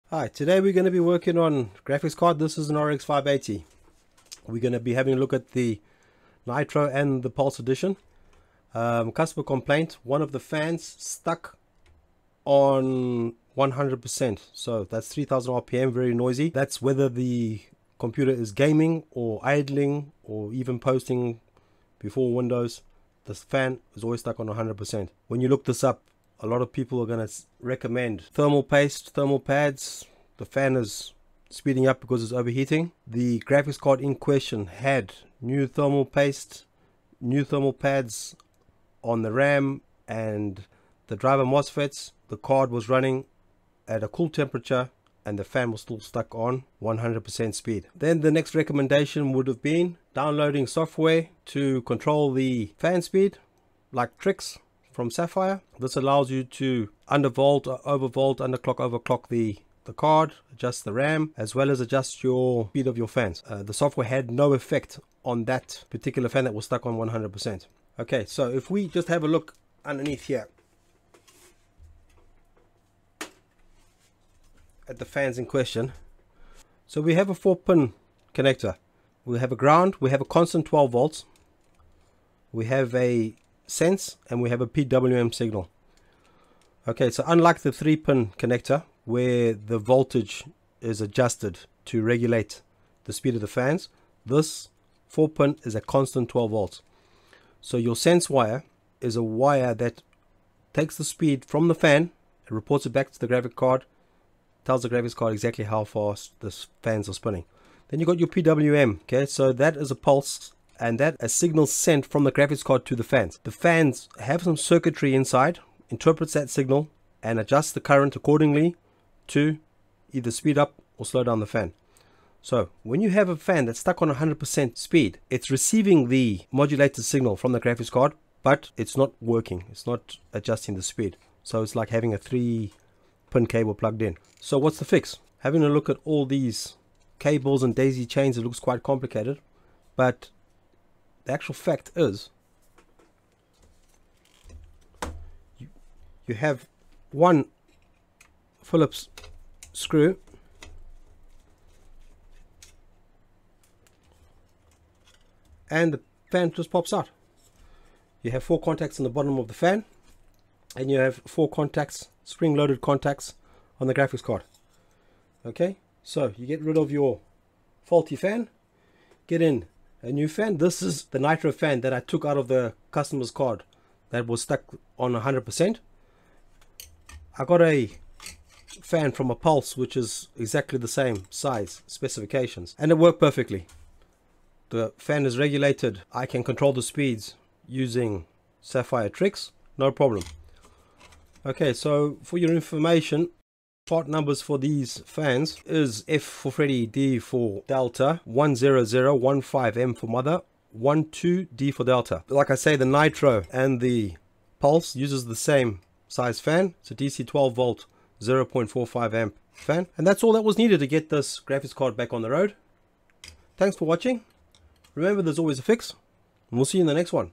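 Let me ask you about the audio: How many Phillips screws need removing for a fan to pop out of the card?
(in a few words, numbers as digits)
1.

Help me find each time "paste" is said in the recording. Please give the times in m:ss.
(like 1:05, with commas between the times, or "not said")
0:28, 0:36.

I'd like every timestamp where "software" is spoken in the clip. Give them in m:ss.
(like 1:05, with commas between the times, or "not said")
0:50, 1:03.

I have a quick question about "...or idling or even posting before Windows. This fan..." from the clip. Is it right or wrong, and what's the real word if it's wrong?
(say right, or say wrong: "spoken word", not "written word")
right.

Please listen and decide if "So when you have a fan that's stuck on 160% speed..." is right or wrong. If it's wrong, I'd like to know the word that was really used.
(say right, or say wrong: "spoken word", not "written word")
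wrong: "100", not "160".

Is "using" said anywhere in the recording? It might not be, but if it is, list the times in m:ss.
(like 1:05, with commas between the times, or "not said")
3:07.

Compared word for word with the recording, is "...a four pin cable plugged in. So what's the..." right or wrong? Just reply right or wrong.
wrong.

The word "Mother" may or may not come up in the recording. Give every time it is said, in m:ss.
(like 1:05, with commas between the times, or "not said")
3:20.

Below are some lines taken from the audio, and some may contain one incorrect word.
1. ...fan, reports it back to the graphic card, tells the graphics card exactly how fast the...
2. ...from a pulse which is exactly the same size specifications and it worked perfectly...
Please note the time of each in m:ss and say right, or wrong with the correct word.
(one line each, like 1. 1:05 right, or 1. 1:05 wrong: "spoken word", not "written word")
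1. 1:41 right
2. 2:59 right.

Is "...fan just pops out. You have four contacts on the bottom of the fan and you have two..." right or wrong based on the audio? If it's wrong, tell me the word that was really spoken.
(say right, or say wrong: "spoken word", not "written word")
wrong: "four", not "two".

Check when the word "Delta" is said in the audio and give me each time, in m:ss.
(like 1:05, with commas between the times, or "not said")
3:17, 3:21.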